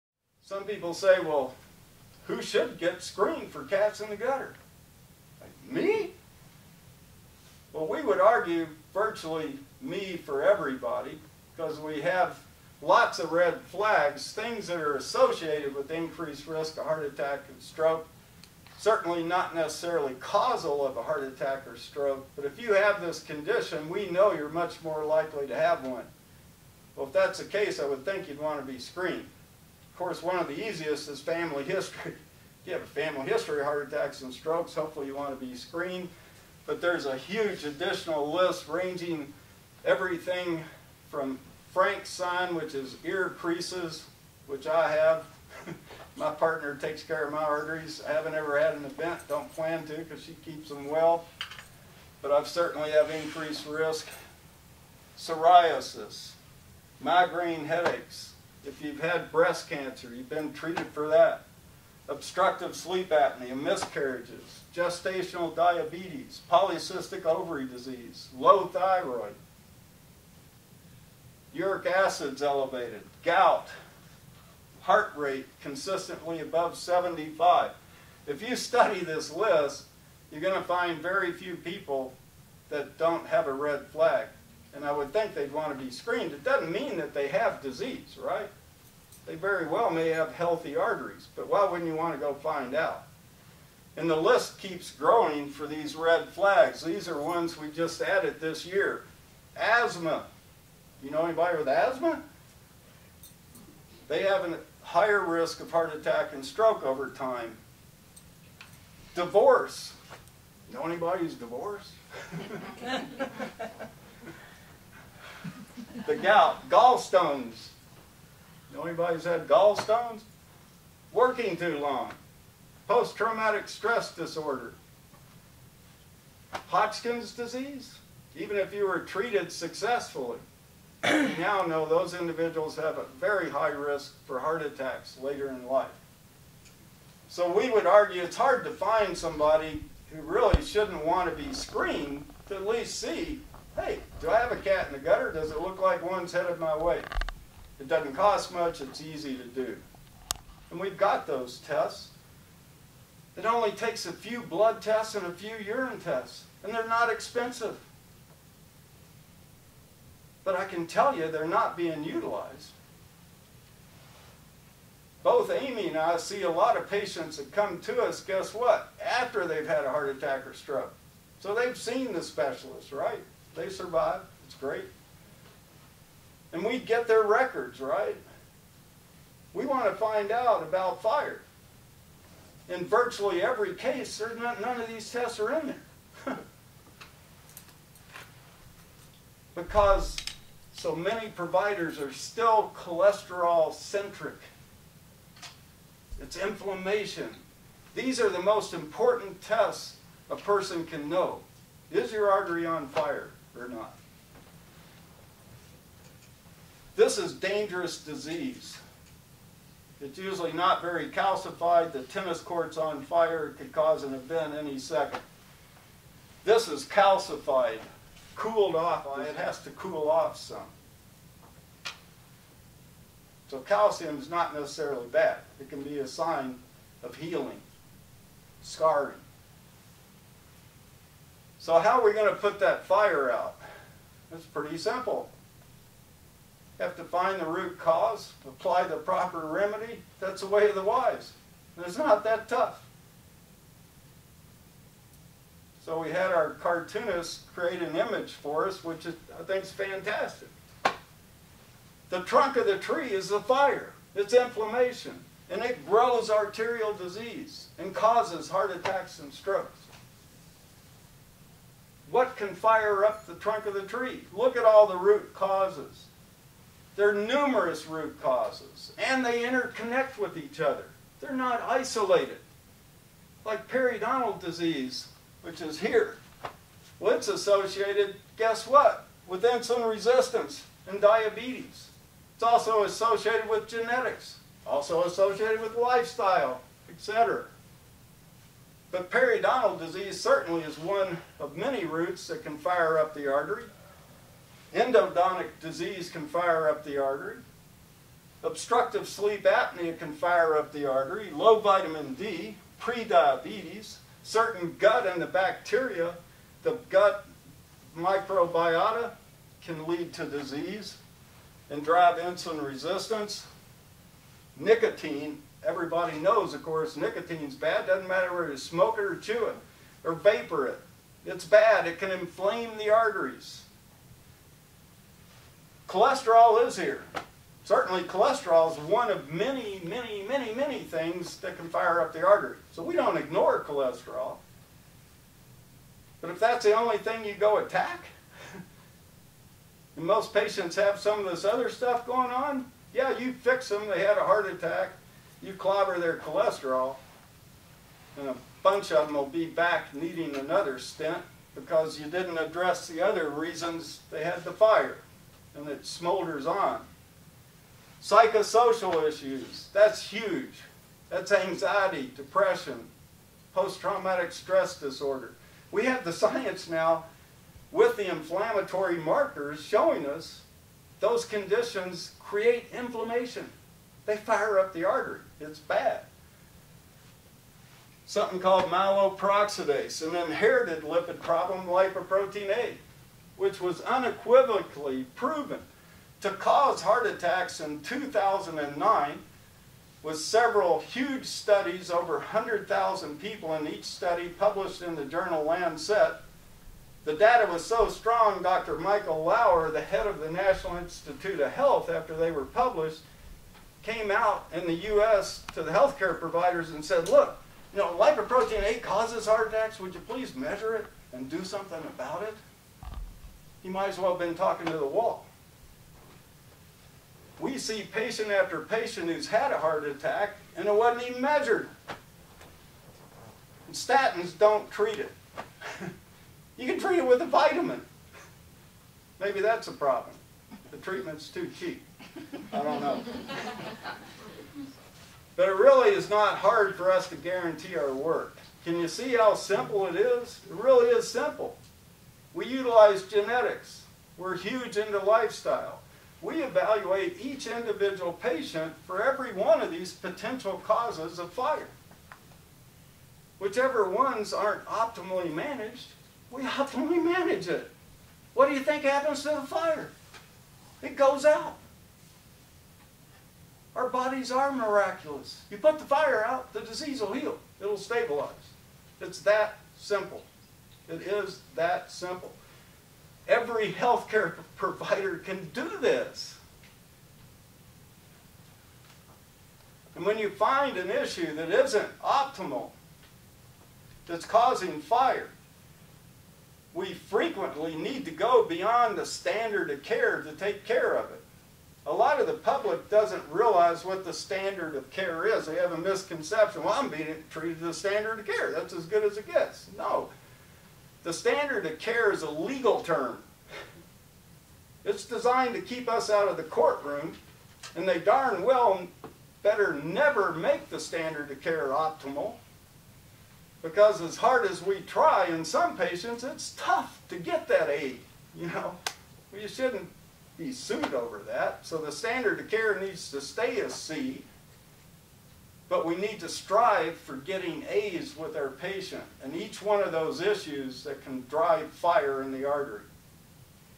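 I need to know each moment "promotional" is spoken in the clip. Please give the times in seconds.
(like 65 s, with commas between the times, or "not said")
not said.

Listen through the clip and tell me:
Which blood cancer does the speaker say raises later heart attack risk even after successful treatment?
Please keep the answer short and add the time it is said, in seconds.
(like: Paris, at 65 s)
Hodgkin's disease, at 126 s.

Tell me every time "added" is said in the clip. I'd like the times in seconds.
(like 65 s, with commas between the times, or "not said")
98 s.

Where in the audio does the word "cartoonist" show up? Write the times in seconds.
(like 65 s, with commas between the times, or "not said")
246 s.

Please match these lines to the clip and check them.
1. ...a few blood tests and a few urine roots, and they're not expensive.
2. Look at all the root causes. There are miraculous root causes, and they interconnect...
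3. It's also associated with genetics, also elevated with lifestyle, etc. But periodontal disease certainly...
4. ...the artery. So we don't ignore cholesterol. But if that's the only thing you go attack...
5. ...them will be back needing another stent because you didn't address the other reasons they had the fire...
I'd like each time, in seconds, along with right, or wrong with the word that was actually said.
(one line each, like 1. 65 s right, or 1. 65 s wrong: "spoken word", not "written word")
1. 154 s wrong: "tests", not "roots"
2. 264 s wrong: "numerous", not "miraculous"
3. 282 s wrong: "associated", not "elevated"
4. 332 s right
5. 349 s right.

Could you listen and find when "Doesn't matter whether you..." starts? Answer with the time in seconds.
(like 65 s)
317 s.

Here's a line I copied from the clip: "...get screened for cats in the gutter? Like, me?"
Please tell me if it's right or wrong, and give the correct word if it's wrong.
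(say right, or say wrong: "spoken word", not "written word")
right.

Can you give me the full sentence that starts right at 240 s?
That's the way of the wise.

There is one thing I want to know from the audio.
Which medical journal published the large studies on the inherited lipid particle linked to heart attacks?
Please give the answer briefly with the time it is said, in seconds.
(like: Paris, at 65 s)
Lancet, at 395 s.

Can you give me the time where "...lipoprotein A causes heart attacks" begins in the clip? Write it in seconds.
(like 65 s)
407 s.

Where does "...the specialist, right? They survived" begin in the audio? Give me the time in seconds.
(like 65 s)
172 s.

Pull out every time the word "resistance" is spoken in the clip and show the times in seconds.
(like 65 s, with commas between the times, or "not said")
279 s, 312 s.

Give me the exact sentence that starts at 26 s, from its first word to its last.
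Well, if that's the case, I would think you'd want to be screened course, one of the easiest is family history.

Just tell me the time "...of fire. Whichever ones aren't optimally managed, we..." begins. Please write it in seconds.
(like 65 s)
451 s.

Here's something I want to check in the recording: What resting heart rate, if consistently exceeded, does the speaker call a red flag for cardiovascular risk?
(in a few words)
75.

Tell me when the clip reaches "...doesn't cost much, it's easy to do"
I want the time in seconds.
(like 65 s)
147 s.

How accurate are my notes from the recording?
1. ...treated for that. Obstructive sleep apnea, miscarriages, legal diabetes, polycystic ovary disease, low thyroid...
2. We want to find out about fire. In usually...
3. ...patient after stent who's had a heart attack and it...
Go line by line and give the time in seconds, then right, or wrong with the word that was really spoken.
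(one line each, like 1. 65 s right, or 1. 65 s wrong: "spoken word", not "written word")
1. 60 s wrong: "gestational", not "legal"
2. 179 s wrong: "virtually", not "usually"
3. 417 s wrong: "patient", not "stent".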